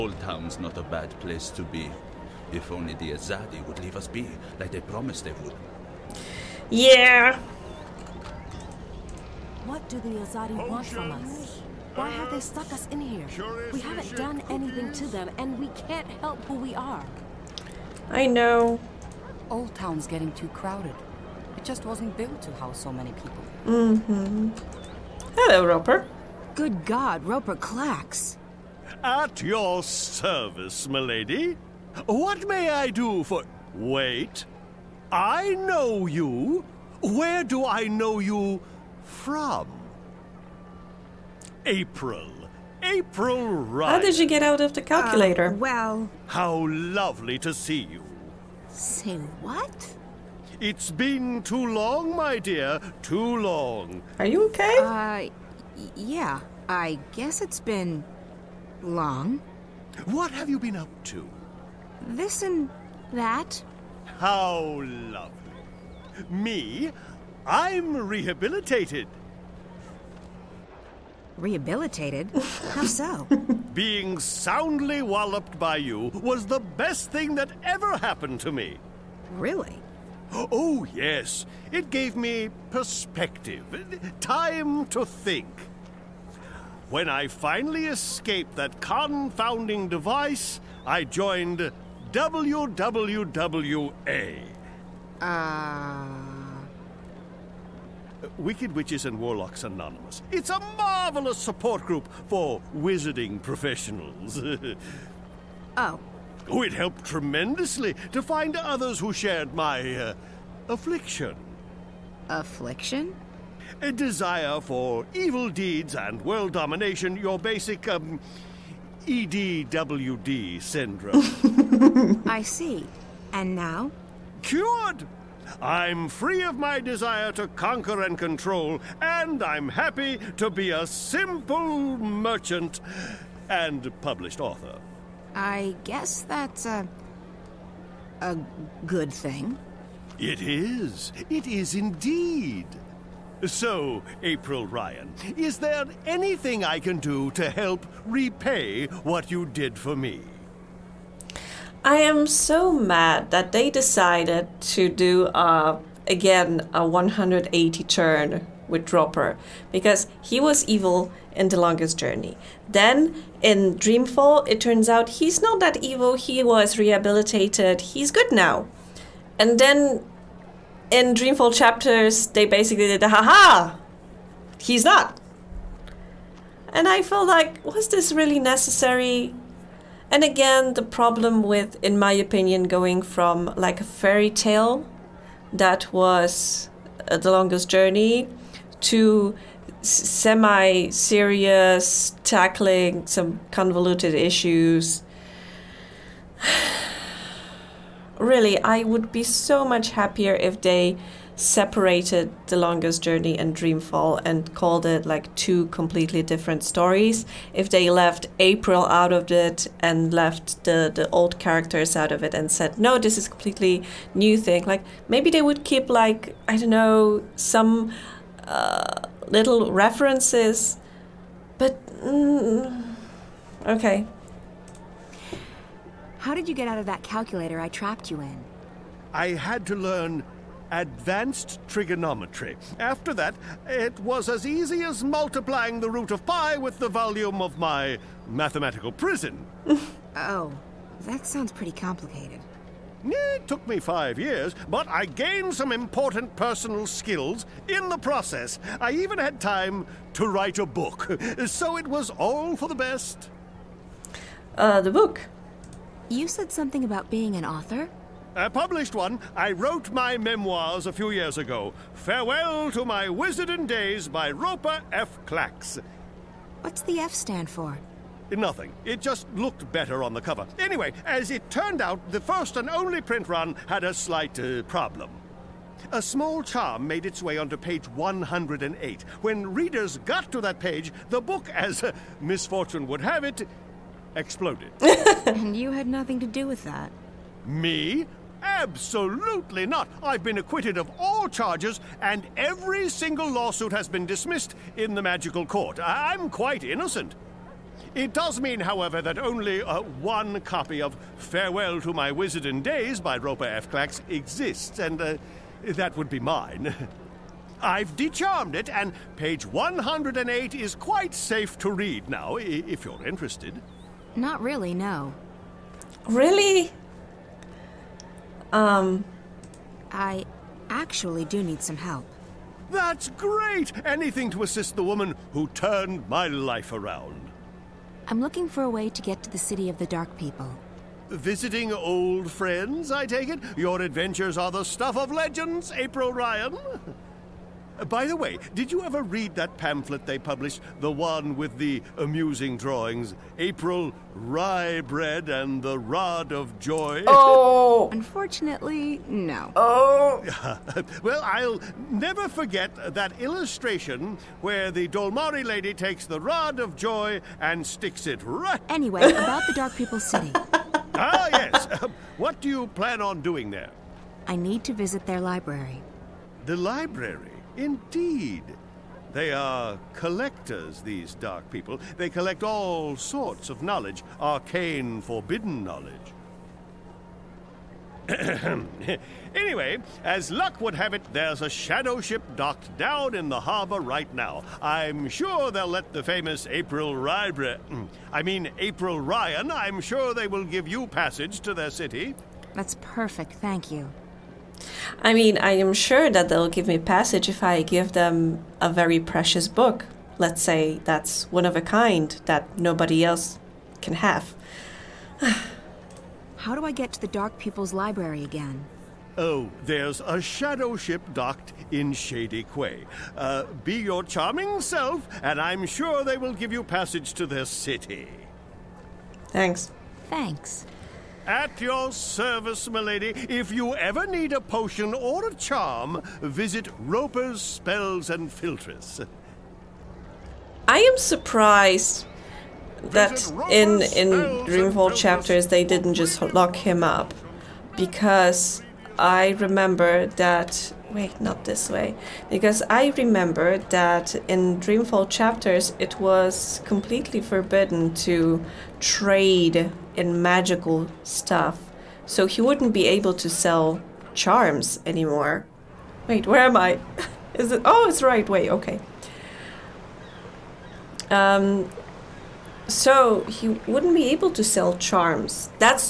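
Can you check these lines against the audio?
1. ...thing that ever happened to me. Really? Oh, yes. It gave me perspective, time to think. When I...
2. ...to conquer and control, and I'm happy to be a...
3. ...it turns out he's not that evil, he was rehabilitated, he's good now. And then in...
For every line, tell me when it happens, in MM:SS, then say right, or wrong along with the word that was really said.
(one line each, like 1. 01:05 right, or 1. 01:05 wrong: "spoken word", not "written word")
1. 01:17 right
2. 02:07 right
3. 02:44 right.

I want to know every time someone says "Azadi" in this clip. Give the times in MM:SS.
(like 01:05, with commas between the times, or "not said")
00:03, 00:10.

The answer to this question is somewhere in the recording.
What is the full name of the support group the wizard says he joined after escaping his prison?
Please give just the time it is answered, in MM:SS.
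01:38.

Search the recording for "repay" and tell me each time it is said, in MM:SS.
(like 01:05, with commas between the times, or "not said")
02:28.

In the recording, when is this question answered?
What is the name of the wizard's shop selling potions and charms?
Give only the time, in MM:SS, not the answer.
07:06.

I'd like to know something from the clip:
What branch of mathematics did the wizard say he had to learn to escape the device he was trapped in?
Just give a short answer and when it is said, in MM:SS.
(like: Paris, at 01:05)
Advanced trigonometry, at 03:50.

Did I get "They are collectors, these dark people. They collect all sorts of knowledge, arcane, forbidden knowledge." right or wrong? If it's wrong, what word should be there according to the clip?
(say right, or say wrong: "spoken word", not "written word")
right.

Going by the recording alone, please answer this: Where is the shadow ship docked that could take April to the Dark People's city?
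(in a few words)
Shady Quay.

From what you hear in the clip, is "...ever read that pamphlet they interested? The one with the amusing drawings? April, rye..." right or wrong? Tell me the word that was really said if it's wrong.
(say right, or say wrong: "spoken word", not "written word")
wrong: "published", not "interested".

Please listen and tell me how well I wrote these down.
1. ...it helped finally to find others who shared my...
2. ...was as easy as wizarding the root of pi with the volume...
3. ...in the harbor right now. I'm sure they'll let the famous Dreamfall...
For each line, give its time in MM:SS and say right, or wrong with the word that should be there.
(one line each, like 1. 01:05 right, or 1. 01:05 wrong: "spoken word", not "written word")
1. 01:46 wrong: "tremendously", not "finally"
2. 03:54 wrong: "multiplying", not "wizarding"
3. 06:23 wrong: "April", not "Dreamfall".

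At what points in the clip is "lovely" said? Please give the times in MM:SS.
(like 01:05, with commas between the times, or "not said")
00:46, 01:04.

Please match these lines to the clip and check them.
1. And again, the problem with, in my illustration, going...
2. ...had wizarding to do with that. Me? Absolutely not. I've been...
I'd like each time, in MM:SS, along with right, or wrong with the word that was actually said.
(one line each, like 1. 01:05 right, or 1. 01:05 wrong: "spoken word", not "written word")
1. 03:00 wrong: "opinion", not "illustration"
2. 04:45 wrong: "nothing", not "wizarding".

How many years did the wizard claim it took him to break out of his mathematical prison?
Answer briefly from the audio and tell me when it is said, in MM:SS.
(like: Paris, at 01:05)
5, at 04:03.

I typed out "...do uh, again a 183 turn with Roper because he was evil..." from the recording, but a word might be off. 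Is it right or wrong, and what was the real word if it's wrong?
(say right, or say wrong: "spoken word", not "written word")
wrong: "180", not "183".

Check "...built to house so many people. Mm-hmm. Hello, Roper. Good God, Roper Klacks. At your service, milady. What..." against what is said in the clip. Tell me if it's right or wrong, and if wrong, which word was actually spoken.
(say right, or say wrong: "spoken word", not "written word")
right.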